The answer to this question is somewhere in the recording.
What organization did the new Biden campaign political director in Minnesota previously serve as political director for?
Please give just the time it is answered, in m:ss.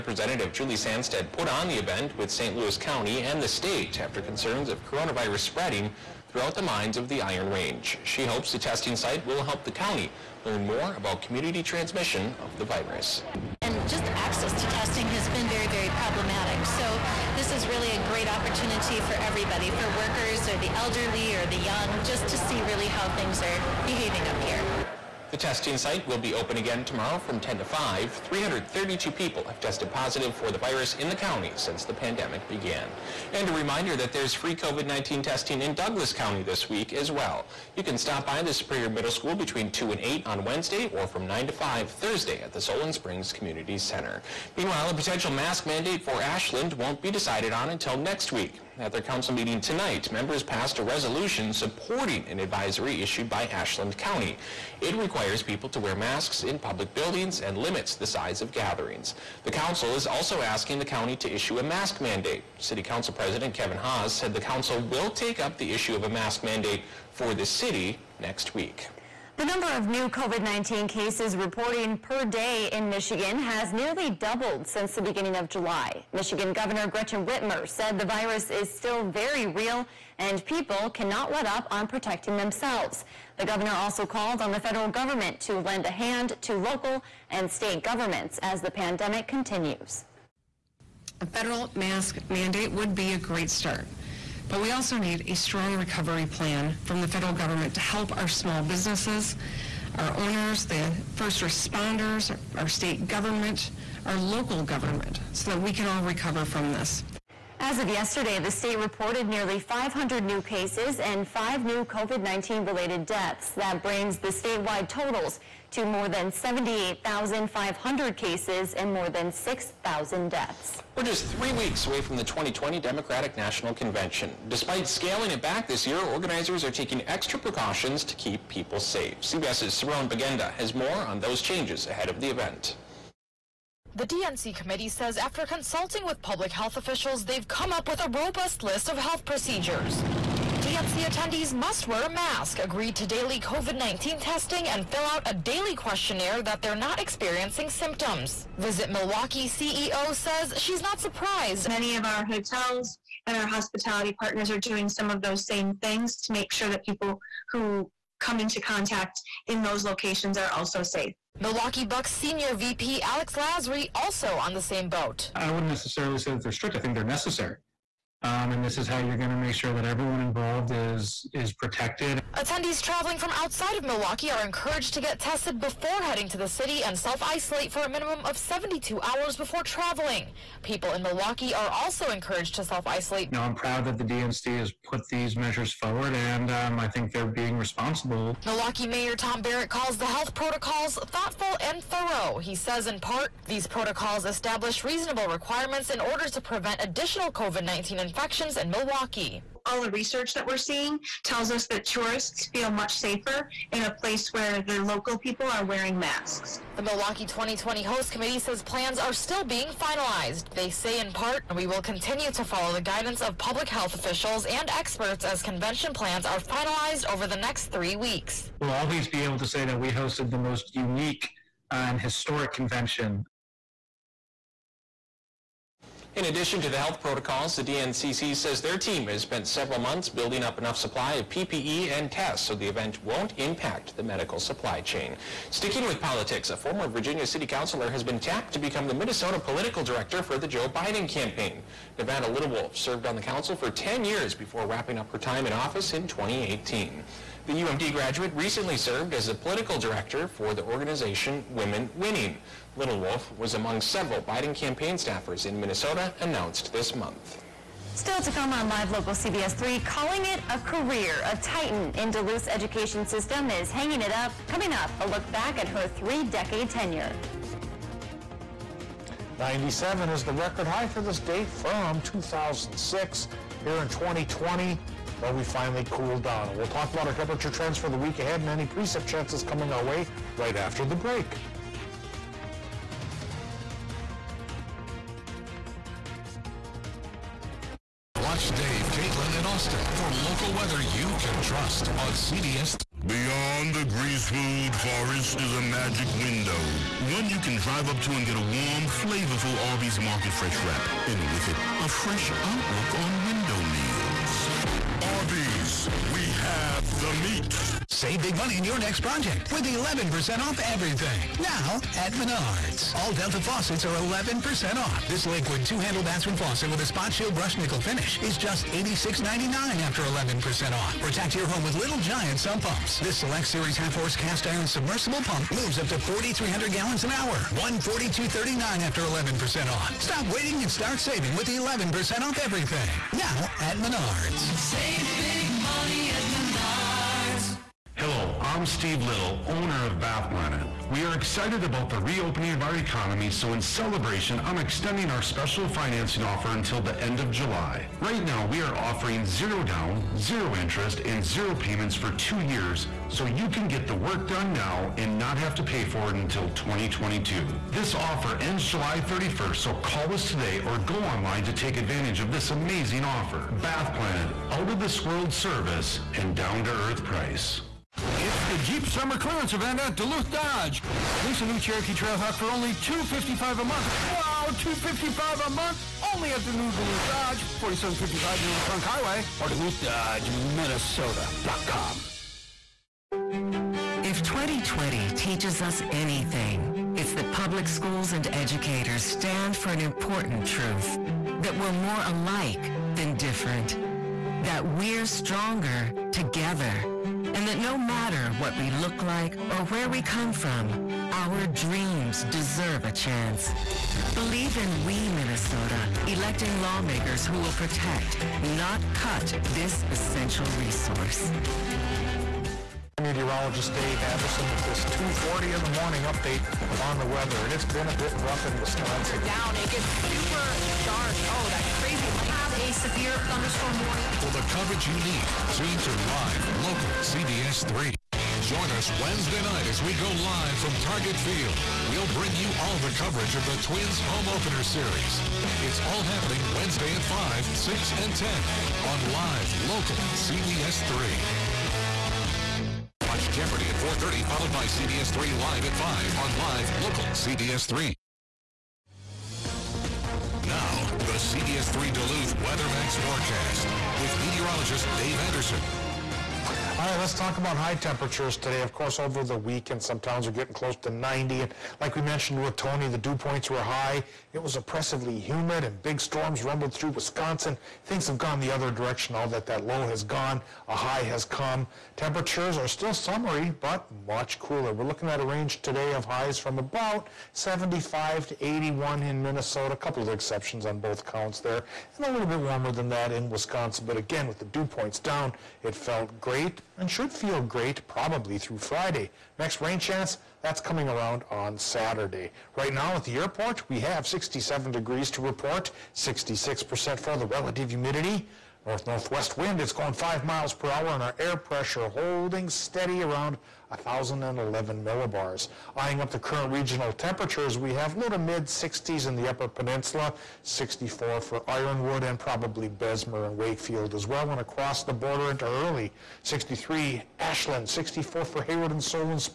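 4:11.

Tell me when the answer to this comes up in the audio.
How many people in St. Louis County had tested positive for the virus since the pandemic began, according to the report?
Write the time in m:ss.
0:28.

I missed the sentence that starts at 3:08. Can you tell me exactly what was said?
Milwaukee Mayor Tom Barrett calls the health protocols thoughtful and thorough.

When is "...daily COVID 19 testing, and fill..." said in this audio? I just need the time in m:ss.
2:23.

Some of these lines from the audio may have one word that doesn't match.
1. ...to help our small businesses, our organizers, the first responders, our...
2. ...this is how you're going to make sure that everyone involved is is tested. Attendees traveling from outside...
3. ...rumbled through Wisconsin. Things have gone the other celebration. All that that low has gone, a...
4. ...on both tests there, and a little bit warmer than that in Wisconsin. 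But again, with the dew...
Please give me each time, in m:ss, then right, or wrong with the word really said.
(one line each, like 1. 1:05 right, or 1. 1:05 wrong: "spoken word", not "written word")
1. 1:37 wrong: "owners", not "organizers"
2. 2:48 wrong: "protected", not "tested"
3. 7:46 wrong: "direction", not "celebration"
4. 8:00 wrong: "counts", not "tests".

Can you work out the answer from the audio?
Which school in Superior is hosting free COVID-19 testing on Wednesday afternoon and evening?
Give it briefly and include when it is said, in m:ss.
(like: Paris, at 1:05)
Superior Middle School, at 0:38.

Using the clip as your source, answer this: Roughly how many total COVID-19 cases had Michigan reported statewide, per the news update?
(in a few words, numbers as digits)
more than 78,500.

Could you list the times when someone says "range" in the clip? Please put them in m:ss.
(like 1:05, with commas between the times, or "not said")
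0:07, 7:55.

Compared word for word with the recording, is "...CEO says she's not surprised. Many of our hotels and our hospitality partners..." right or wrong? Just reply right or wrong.
right.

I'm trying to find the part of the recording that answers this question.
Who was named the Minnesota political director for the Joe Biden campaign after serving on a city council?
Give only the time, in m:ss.
4:01.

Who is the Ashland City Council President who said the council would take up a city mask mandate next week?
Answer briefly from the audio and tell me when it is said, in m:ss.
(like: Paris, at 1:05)
Kevin Haas, at 1:03.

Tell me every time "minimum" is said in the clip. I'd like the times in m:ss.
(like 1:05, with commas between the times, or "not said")
2:57.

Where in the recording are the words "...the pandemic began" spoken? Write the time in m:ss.
0:31.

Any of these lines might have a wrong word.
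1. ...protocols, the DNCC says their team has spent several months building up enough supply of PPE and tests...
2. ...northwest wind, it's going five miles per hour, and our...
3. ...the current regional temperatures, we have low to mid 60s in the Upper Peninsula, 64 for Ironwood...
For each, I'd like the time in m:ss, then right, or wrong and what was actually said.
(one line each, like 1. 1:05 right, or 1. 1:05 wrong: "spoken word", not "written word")
1. 3:47 right
2. 8:18 right
3. 8:26 right.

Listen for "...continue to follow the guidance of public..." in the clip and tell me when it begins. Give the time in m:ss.
3:31.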